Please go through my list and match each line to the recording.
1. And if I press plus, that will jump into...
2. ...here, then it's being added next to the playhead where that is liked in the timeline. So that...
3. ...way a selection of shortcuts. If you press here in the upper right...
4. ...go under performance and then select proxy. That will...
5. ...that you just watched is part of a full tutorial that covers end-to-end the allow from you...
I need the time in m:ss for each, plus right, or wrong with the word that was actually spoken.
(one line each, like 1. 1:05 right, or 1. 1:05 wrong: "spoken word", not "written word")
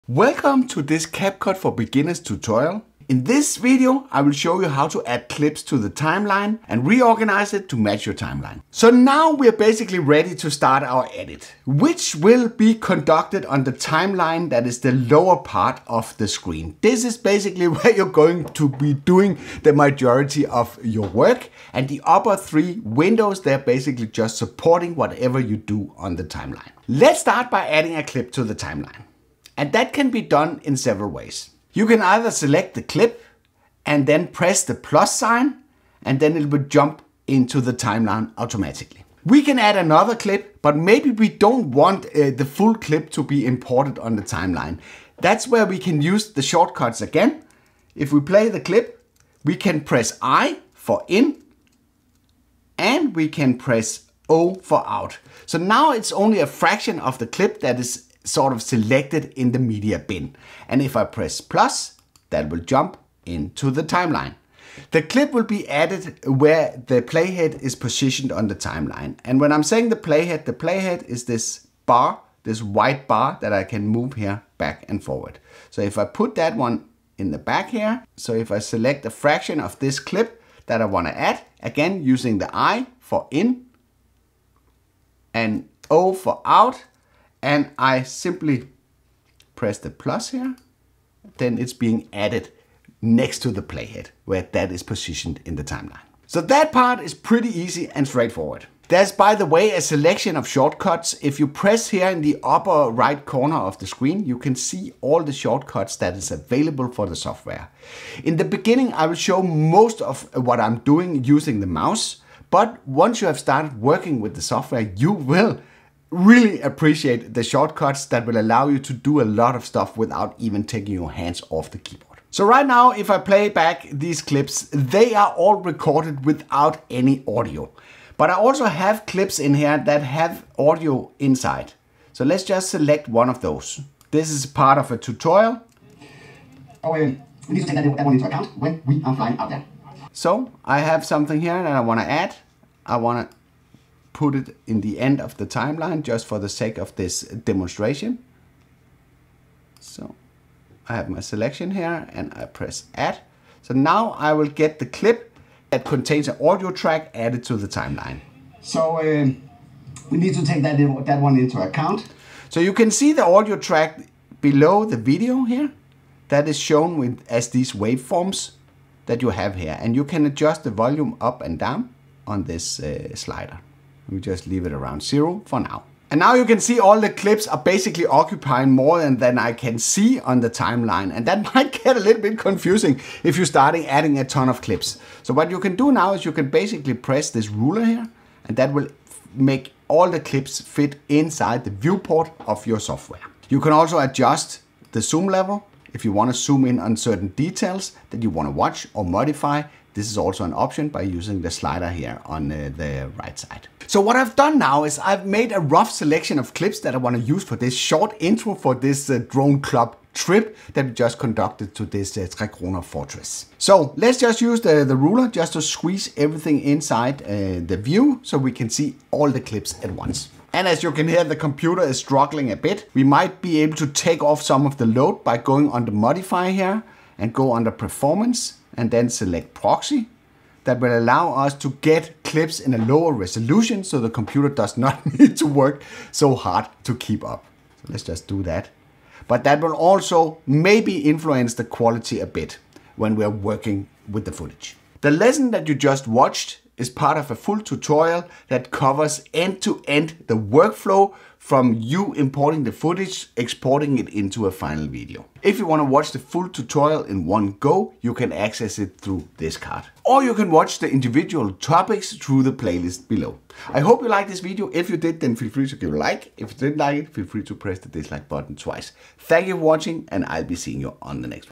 1. 1:00 right
2. 1:30 wrong: "positioned", not "liked"
3. 1:39 right
4. 3:47 right
5. 4:05 wrong: "workflow", not "allow".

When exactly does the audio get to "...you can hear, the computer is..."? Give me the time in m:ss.
3:40.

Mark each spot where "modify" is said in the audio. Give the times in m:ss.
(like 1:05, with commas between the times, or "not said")
3:19, 3:45.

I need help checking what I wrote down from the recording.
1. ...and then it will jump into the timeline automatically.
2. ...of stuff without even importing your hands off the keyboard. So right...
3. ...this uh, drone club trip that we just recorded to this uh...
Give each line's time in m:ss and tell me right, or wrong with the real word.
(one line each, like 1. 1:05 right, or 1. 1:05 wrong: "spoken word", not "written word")
1. 0:36 right
2. 1:59 wrong: "taking", not "importing"
3. 3:28 wrong: "conducted", not "recorded".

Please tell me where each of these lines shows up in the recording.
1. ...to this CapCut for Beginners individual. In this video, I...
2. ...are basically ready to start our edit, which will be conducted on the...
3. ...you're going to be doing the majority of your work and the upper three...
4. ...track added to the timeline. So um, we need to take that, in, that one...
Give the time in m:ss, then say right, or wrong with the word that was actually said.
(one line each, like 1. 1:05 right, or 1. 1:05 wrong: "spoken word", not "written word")
1. 0:00 wrong: "tutorial", not "individual"
2. 0:09 right
3. 0:17 right
4. 2:36 right.